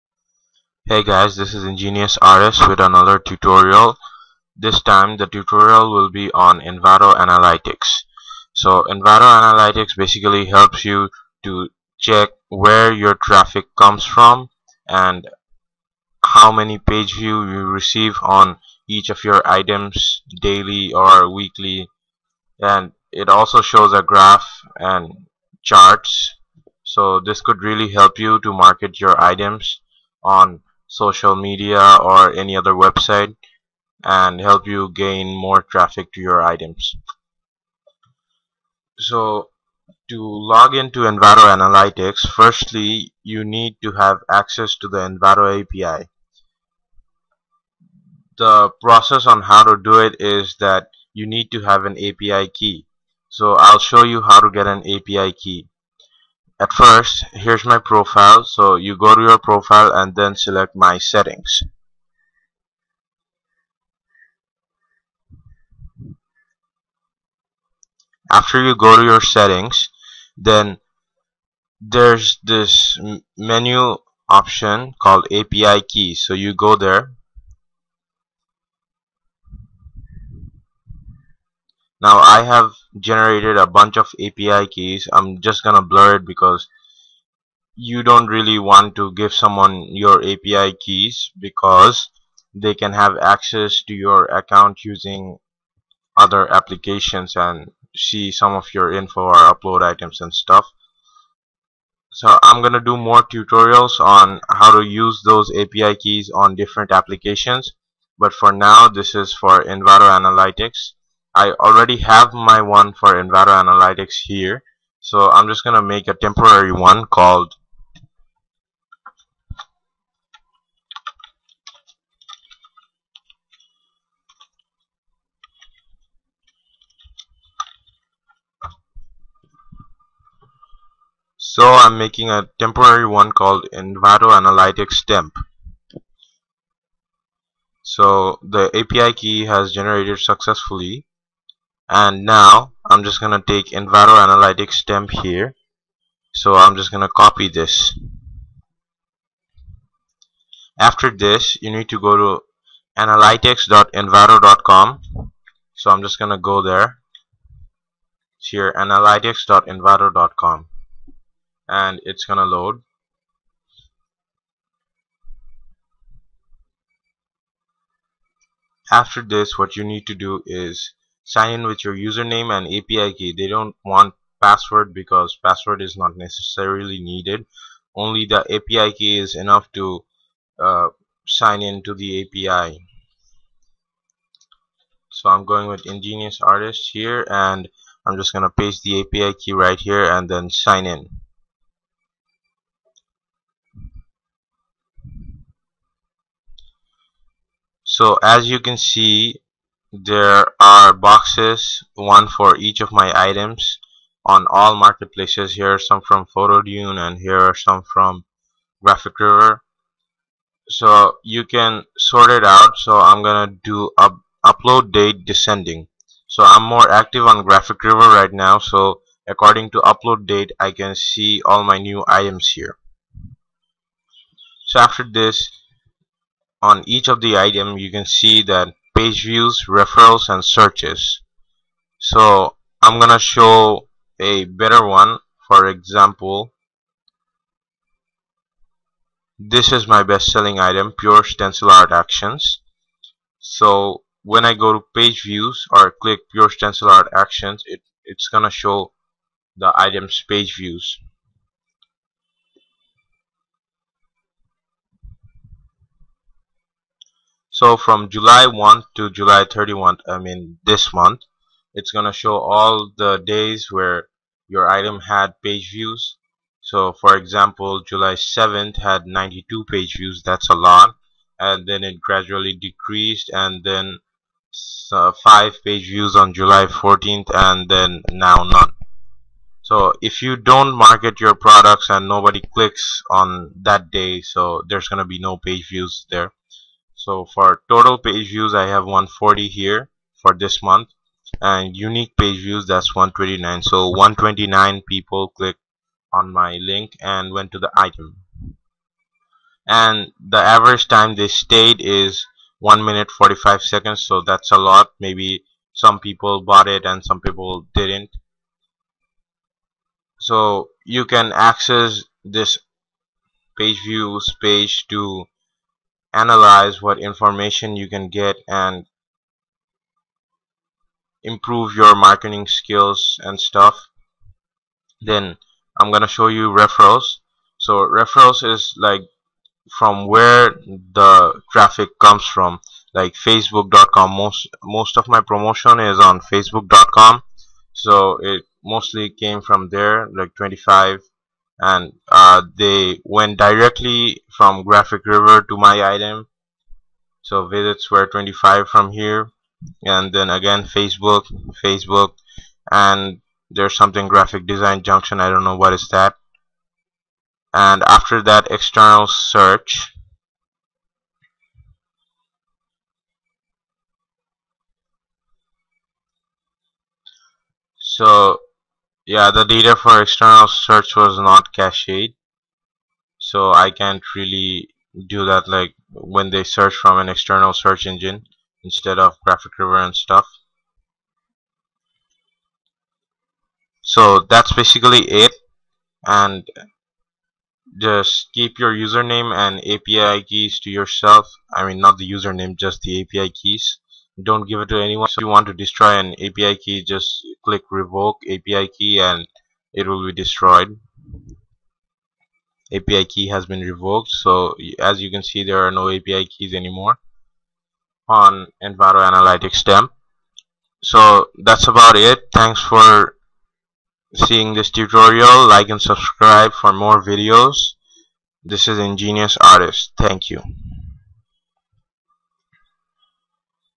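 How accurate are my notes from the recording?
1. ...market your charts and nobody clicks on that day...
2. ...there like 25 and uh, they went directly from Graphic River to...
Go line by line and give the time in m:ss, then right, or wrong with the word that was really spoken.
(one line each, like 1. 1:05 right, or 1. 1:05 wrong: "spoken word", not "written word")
1. 4:40 wrong: "products", not "charts"
2. 5:39 right.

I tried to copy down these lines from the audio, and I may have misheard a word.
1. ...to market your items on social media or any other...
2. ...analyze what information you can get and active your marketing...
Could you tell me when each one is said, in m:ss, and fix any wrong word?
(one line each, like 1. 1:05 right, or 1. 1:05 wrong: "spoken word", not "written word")
1. 0:28 right
2. 5:16 wrong: "improve", not "active".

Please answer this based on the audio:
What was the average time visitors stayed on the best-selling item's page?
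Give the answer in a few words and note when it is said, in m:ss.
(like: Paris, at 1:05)
1 minute 45 seconds, at 5:02.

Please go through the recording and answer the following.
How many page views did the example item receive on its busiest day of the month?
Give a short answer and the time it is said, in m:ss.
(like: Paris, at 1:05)
92, at 4:29.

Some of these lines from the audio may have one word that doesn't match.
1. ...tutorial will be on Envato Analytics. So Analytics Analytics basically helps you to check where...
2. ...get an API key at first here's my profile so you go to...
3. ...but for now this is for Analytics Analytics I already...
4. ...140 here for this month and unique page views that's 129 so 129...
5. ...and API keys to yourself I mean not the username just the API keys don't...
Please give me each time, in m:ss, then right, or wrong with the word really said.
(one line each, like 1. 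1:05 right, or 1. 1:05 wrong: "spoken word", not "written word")
1. 0:05 wrong: "Envato", not "Analytics"
2. 0:54 right
3. 1:48 wrong: "Envato", not "Analytics"
4. 4:48 right
5. 6:29 right.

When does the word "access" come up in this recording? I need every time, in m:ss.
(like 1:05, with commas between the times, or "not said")
0:44, 1:33, 5:11.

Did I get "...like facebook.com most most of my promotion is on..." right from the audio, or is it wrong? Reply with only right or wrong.
right.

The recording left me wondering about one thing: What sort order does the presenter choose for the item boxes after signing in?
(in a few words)
Upload date descending.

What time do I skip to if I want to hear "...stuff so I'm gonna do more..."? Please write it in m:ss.
1:40.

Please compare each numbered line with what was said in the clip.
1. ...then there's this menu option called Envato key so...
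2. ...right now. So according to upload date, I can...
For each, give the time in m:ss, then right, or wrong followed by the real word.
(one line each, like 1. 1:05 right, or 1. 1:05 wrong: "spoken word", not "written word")
1. 1:10 wrong: "API", not "Envato"
2. 3:38 right.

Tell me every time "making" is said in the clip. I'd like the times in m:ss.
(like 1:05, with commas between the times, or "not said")
2:11.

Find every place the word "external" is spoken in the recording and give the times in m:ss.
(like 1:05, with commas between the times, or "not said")
5:58, 6:10, 6:17.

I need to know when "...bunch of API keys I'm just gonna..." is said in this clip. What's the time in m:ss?
1:23.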